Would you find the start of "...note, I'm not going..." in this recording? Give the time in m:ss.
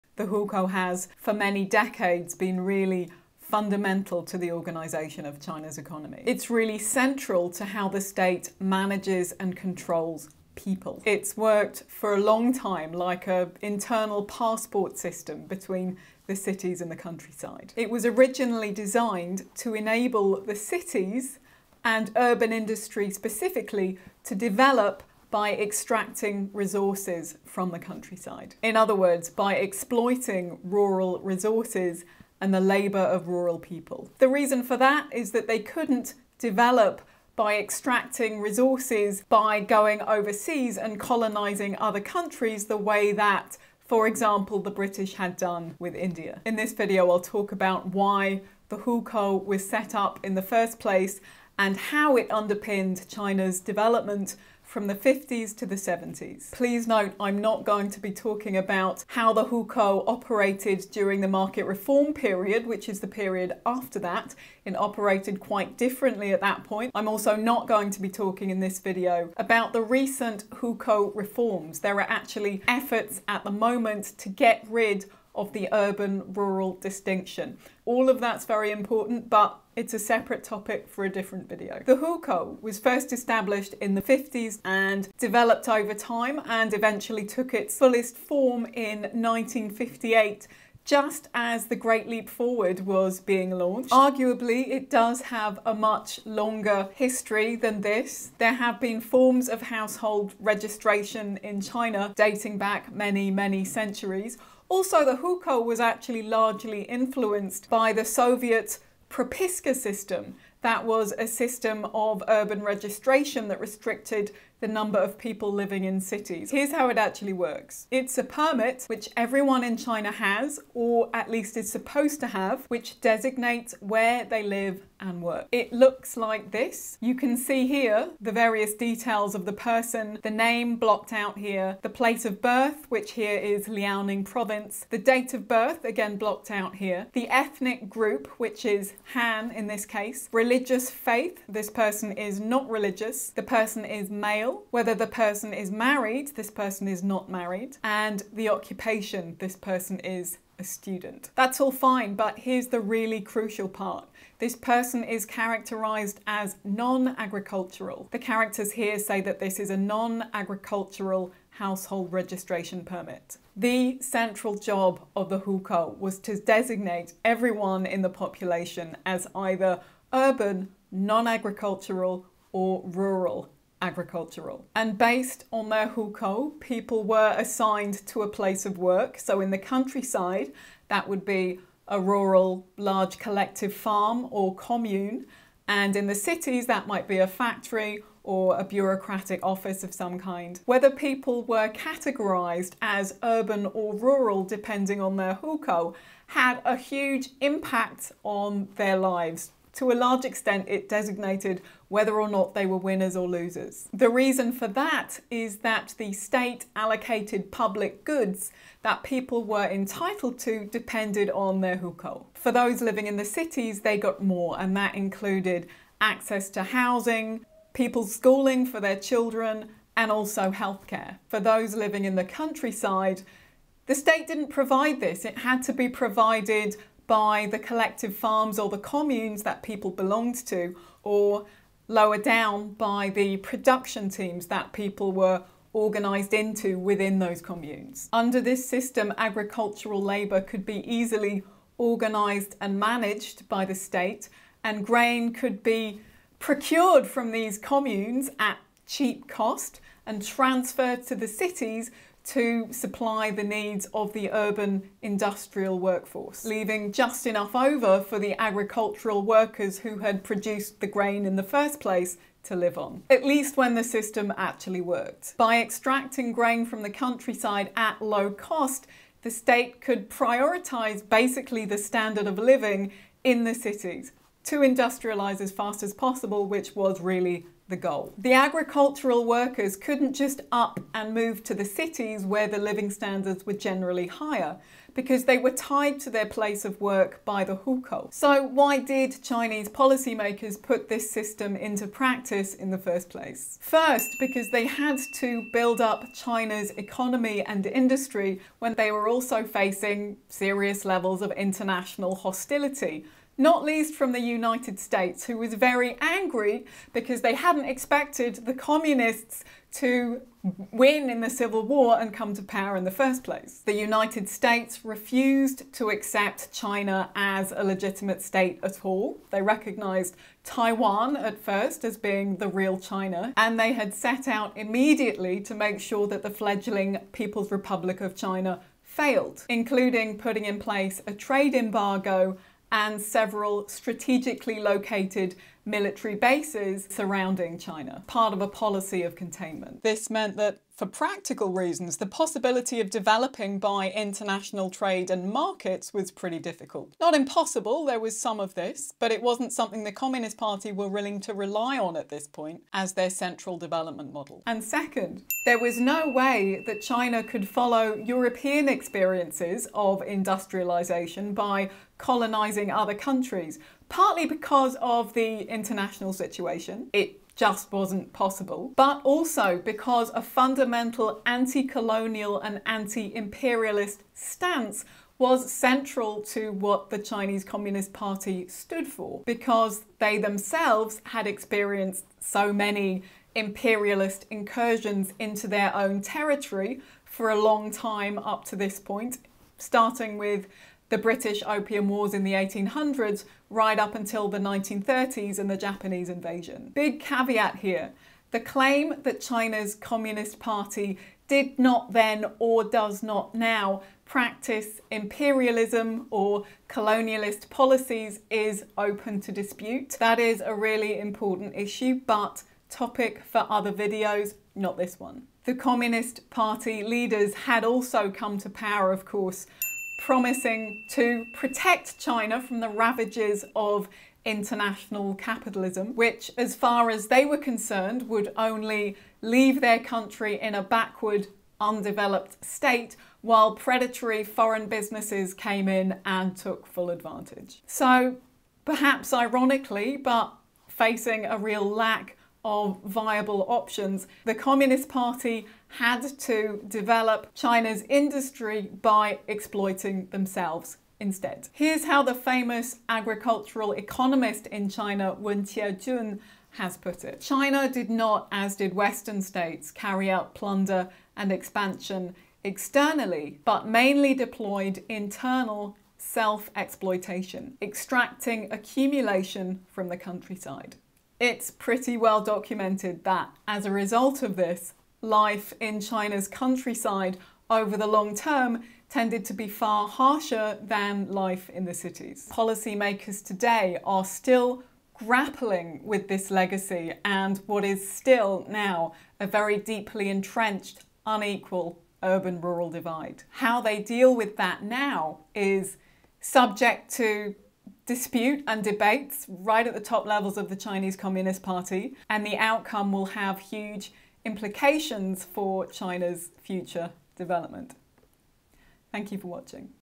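0:56.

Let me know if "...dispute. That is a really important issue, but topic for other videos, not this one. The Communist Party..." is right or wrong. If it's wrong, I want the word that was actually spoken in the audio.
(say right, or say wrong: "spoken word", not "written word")
right.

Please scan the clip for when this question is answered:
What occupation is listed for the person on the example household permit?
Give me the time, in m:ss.
2:30.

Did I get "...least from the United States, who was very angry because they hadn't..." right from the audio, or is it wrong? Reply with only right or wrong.
right.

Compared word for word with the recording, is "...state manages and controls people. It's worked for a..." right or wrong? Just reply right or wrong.
right.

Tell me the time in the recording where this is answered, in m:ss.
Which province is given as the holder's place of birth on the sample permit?
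2:13.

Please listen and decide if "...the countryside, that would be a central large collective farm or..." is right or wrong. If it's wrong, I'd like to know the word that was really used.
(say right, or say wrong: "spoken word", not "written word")
wrong: "rural", not "central".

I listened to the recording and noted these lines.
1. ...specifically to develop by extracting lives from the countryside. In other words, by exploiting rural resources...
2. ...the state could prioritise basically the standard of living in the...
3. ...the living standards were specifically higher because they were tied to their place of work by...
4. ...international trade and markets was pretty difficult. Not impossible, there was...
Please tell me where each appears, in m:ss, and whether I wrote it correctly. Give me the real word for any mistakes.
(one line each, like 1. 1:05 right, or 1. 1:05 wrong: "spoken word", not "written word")
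1. 0:23 wrong: "resources", not "lives"
2. 4:29 right
3. 4:42 wrong: "generally", not "specifically"
4. 5:43 right.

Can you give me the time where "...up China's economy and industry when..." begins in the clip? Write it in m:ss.
4:55.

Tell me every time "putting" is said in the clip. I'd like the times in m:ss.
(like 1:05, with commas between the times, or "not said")
5:30.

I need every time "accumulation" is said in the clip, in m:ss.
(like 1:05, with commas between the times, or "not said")
7:48.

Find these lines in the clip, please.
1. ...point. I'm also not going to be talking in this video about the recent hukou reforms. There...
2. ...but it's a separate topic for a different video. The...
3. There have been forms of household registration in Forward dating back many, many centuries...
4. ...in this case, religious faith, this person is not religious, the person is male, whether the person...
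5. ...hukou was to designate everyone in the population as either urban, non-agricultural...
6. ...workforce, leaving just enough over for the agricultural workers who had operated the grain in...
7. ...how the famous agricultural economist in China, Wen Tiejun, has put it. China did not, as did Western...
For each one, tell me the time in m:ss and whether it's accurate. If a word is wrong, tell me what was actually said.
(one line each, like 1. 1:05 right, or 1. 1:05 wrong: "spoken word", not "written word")
1. 1:06 right
2. 1:19 right
3. 1:38 wrong: "China", not "Forward"
4. 2:19 right
5. 2:45 right
6. 4:15 wrong: "produced", not "operated"
7. 7:31 right.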